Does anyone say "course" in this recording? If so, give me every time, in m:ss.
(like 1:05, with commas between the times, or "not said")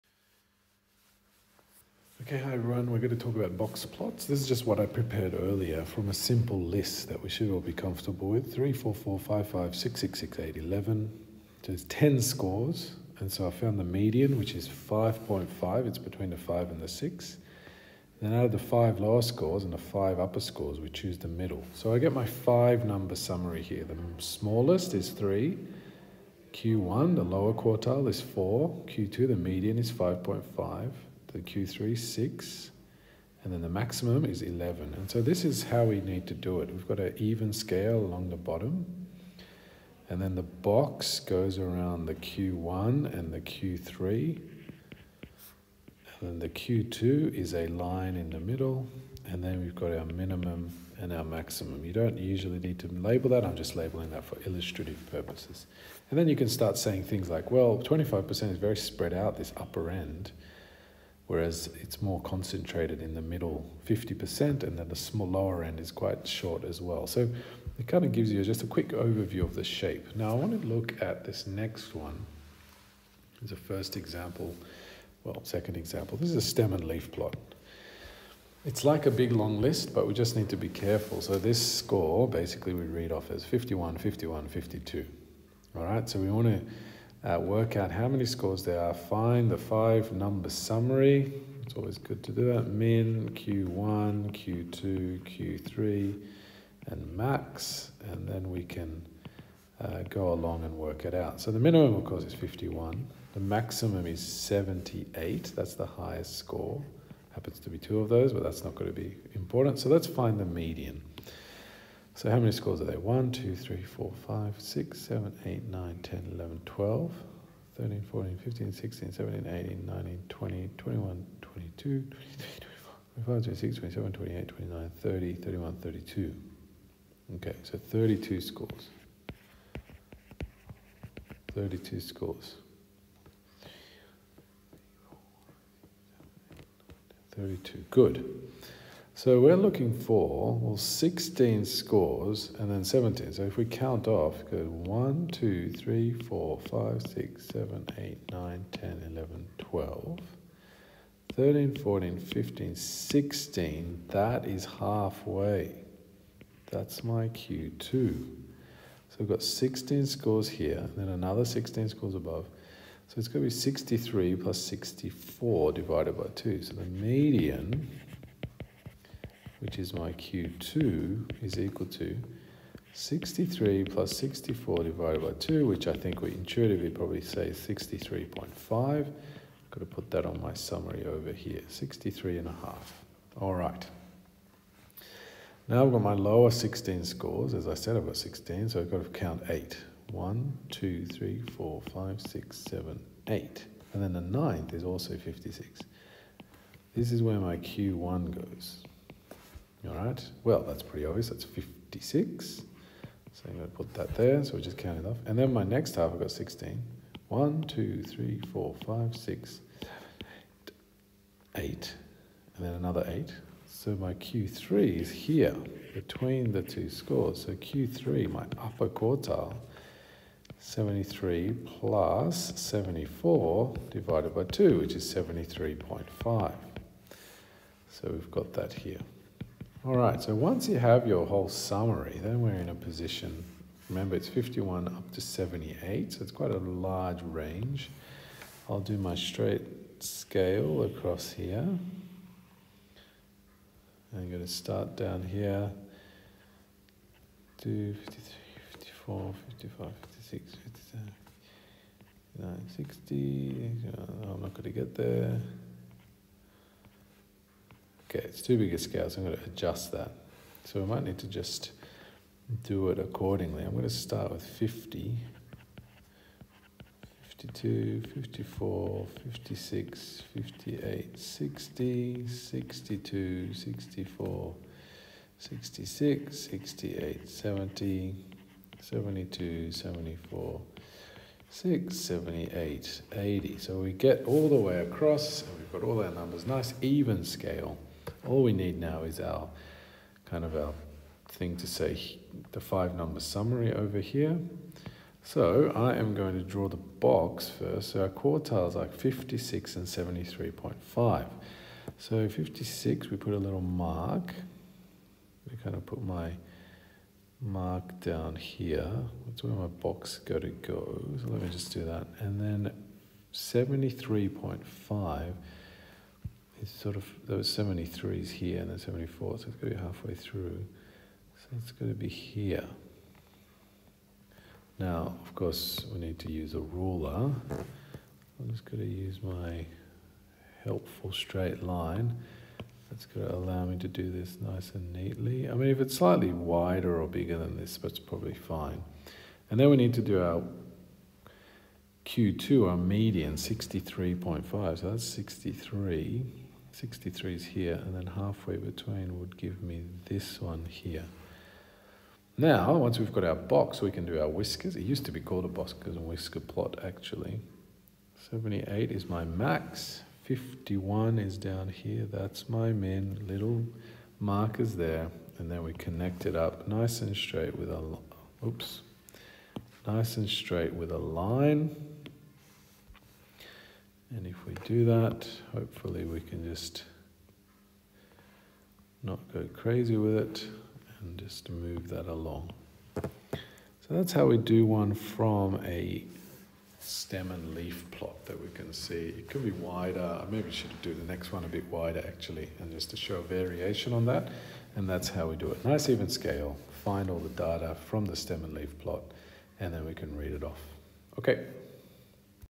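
1:42, 5:25.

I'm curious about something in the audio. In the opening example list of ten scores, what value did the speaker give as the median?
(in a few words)
5.5.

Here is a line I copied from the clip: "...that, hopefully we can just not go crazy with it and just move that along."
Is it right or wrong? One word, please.
right.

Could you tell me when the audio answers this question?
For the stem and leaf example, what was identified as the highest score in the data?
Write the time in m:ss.
1:43.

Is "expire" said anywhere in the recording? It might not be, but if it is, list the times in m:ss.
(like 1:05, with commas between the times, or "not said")
not said.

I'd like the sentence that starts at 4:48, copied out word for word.
All we need now is our kind of our thing to say the five number summary over here.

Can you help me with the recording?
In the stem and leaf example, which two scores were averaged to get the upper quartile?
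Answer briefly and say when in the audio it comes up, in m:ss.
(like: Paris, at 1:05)
73 and 74, at 3:40.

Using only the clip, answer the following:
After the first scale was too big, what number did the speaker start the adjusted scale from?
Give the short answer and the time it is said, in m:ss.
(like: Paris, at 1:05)
50, at 4:23.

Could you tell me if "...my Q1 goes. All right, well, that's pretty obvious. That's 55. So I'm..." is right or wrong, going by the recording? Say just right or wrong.
wrong.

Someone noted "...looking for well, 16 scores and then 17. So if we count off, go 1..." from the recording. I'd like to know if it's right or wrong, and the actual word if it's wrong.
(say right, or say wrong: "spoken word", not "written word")
right.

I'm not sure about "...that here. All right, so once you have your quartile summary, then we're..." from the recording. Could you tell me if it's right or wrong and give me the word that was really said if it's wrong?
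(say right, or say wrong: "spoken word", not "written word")
wrong: "whole", not "quartile".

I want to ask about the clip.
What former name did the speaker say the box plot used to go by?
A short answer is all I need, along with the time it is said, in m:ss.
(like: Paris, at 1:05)
Boskers and Whisker plot, at 5:55.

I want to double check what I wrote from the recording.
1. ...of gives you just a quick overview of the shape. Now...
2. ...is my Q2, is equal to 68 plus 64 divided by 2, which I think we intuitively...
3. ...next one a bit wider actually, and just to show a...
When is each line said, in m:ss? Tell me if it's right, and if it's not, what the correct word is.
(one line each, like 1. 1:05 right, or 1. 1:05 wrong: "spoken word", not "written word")
1. 1:08 right
2. 2:49 wrong: "63", not "68"
3. 6:31 right.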